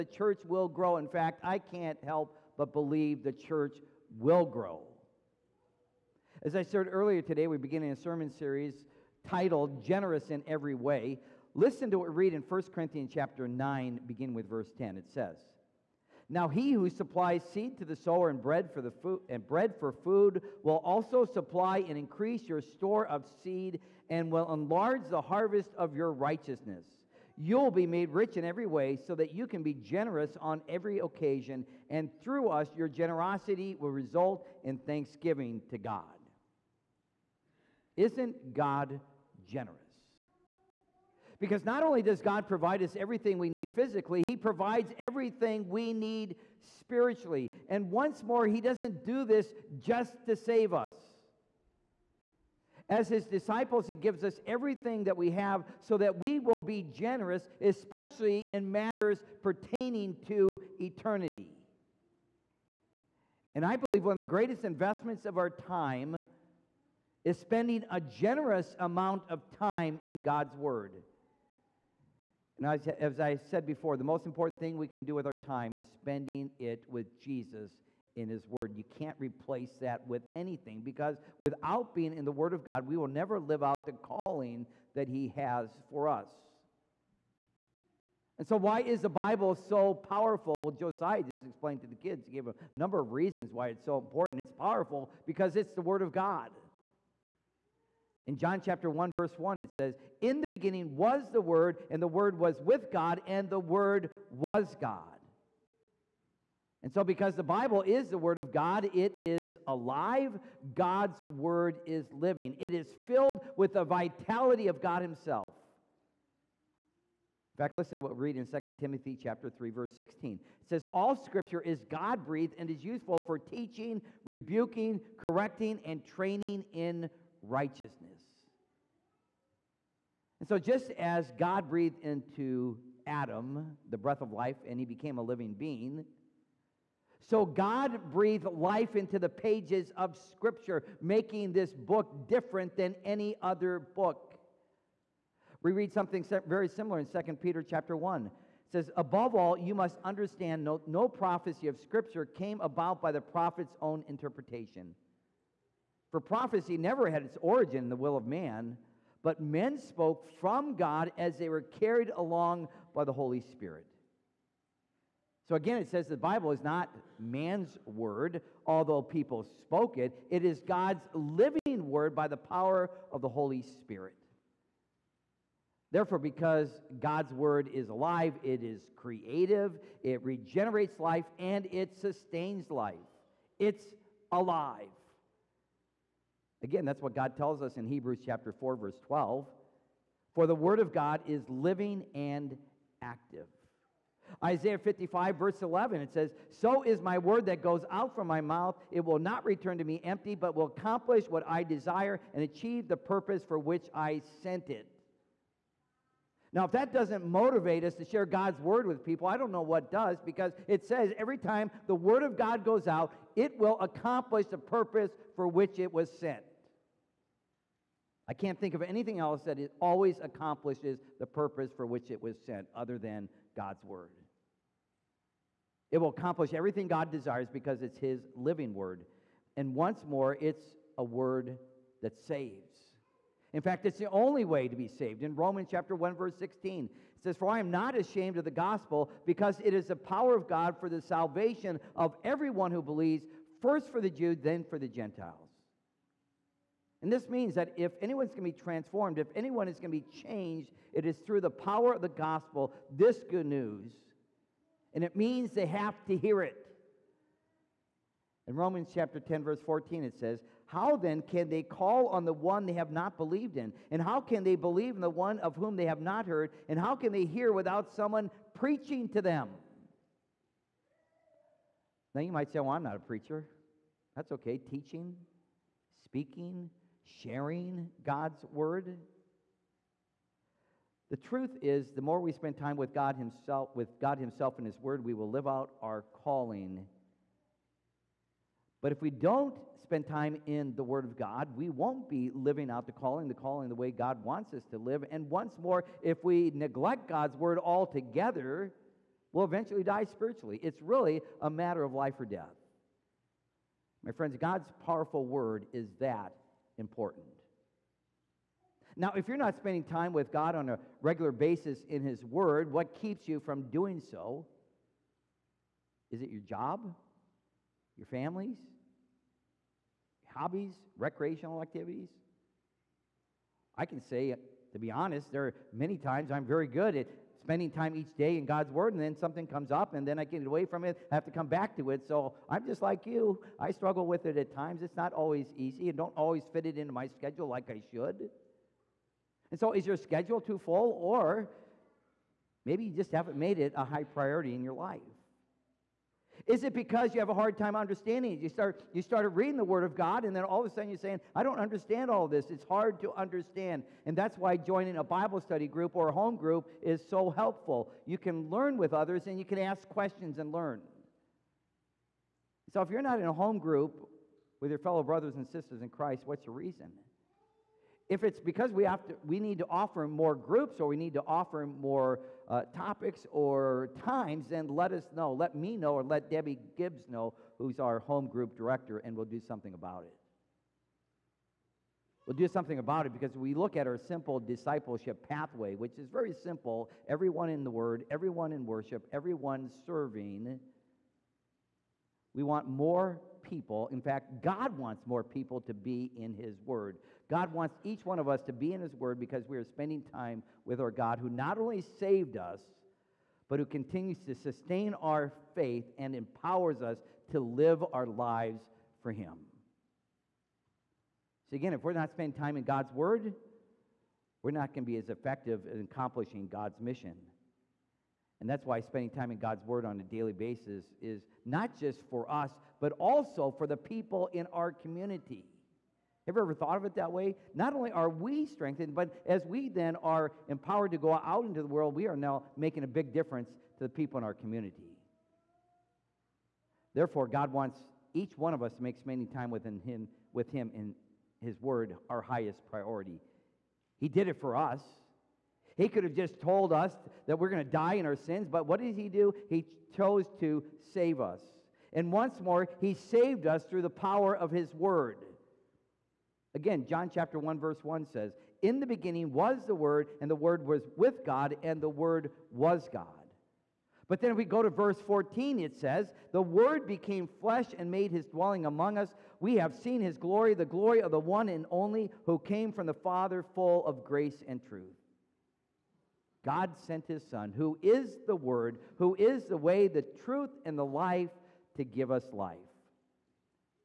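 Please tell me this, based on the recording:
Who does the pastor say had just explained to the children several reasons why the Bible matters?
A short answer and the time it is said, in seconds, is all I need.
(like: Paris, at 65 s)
Josiah, at 90 s.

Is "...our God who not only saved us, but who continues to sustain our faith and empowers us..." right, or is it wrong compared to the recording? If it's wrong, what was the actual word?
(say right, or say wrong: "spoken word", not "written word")
right.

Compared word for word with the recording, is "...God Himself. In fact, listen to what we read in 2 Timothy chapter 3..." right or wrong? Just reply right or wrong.
right.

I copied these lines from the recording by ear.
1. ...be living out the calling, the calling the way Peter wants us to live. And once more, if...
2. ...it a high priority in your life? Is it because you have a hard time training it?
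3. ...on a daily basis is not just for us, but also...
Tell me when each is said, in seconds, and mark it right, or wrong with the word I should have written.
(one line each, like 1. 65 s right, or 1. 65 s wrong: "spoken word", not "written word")
1. 292 s wrong: "God", not "Peter"
2. 343 s wrong: "understanding", not "training"
3. 419 s right.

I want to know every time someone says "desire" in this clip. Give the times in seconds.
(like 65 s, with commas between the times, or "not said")
201 s, 227 s.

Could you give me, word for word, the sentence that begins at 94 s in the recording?
It's powerful because it's the Word of God.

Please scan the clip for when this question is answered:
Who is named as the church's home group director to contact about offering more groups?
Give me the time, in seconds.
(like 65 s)
376 s.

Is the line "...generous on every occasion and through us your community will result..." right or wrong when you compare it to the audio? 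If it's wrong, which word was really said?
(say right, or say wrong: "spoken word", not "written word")
wrong: "generosity", not "community".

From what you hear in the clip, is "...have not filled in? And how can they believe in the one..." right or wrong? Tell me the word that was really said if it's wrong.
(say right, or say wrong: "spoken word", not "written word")
wrong: "believed", not "filled".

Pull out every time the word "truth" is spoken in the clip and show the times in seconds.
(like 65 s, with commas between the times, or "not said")
281 s, 474 s, 480 s.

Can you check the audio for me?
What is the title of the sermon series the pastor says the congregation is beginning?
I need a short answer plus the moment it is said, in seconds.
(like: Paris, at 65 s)
Generous in Every Way, at 9 s.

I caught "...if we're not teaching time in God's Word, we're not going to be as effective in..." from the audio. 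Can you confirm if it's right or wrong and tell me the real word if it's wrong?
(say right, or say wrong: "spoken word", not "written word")
wrong: "spending", not "teaching".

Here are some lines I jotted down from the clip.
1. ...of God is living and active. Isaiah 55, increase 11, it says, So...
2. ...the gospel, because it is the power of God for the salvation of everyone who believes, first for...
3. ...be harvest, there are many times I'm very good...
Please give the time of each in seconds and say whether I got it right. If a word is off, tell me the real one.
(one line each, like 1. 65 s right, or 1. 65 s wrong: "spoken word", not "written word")
1. 190 s wrong: "verse", not "increase"
2. 238 s right
3. 324 s wrong: "honest", not "harvest".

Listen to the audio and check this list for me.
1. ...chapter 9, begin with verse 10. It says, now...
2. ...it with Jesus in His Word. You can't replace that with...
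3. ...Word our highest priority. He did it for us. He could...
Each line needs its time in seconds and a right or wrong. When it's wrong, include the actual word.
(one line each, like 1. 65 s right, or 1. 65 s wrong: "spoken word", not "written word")
1. 13 s right
2. 76 s right
3. 441 s right.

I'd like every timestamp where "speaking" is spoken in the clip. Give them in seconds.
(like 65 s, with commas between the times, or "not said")
276 s.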